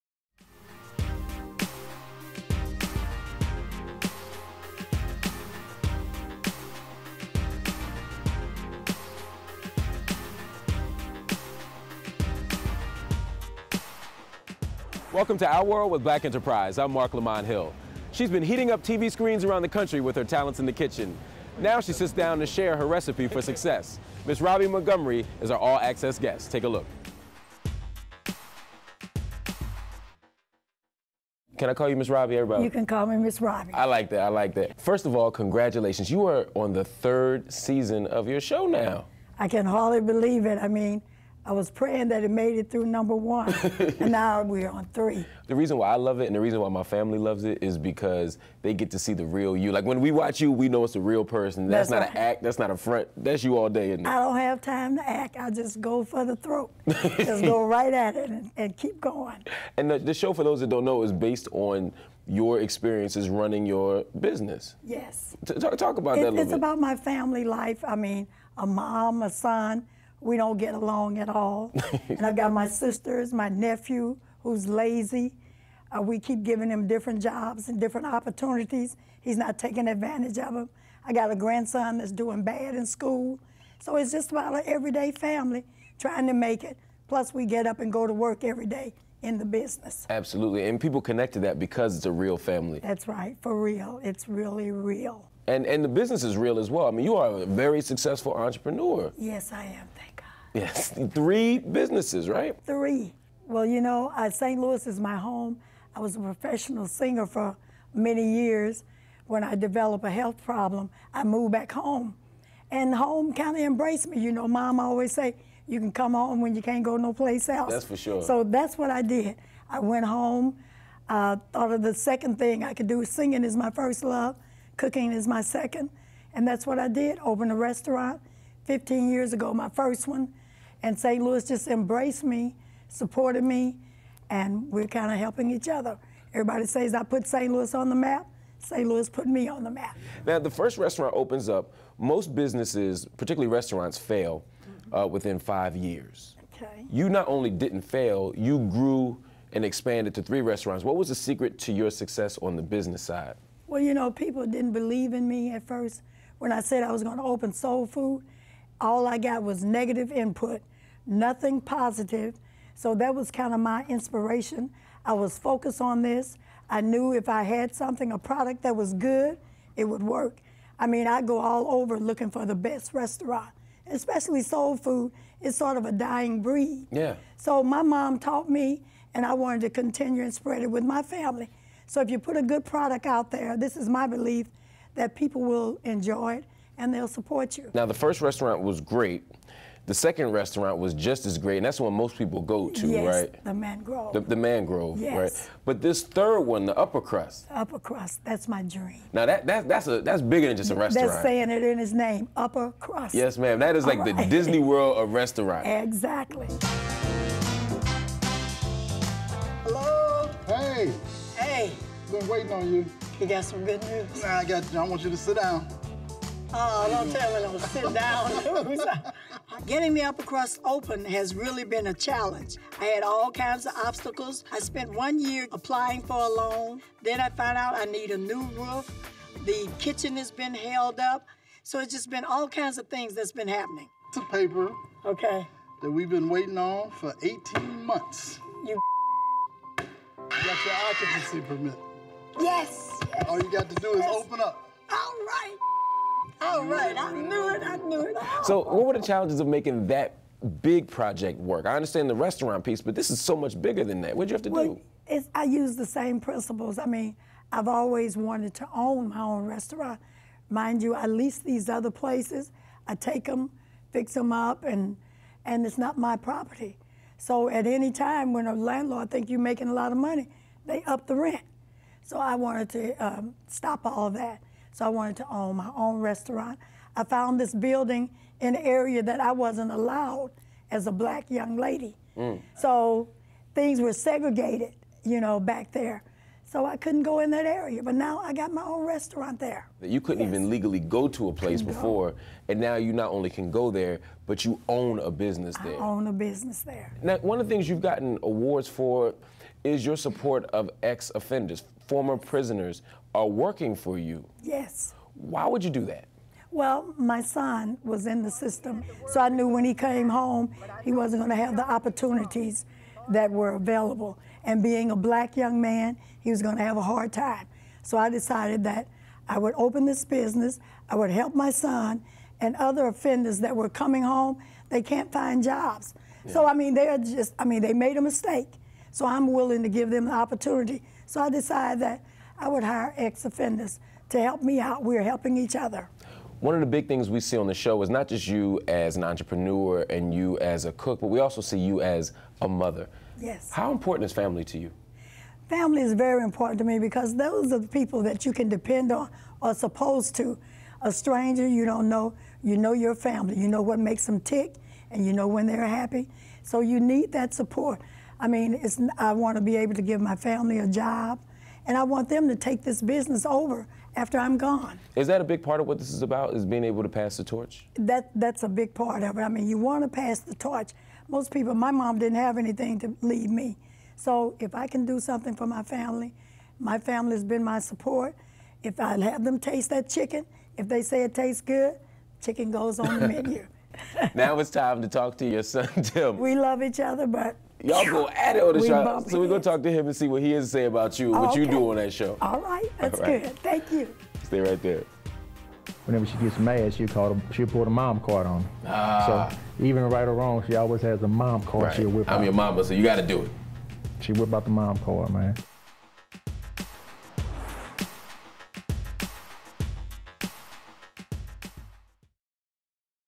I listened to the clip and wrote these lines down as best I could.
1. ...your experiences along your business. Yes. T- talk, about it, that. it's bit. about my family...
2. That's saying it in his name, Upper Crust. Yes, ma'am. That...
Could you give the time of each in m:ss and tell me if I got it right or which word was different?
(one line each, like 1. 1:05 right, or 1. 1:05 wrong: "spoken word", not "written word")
1. 1:02 wrong: "running", not "along"
2. 3:21 right.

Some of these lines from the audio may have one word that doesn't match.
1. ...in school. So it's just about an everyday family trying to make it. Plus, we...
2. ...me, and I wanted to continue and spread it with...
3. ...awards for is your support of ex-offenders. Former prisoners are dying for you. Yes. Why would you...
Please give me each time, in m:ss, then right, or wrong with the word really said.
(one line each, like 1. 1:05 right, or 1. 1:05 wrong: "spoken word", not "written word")
1. 1:22 right
2. 2:58 right
3. 4:58 wrong: "working", not "dying".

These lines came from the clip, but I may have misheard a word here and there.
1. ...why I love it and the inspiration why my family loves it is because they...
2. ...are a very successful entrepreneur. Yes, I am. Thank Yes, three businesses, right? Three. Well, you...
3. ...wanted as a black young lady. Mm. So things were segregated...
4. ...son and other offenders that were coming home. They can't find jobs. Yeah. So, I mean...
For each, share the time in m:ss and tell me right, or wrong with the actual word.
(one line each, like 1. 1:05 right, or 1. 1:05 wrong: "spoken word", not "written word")
1. 0:45 wrong: "reason", not "inspiration"
2. 1:37 right
3. 4:39 wrong: "allowed", not "wanted"
4. 5:21 right.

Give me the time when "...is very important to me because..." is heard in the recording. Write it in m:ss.
5:45.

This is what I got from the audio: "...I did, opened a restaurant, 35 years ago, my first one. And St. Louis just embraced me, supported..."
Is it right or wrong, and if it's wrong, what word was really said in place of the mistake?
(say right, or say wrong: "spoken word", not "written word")
wrong: "15", not "35".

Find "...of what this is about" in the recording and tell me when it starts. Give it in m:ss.
6:05.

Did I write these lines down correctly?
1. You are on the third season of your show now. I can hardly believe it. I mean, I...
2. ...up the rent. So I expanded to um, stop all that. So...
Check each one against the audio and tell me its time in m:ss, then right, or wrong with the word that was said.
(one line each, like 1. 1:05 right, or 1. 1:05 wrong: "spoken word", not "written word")
1. 0:36 right
2. 4:30 wrong: "wanted", not "expanded".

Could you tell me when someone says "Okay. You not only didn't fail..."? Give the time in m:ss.
2:26.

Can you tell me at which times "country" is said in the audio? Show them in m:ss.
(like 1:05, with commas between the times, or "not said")
0:19.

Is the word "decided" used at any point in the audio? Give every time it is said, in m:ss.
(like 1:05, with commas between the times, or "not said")
5:18, 5:31.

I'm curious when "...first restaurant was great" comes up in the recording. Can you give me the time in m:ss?
3:07.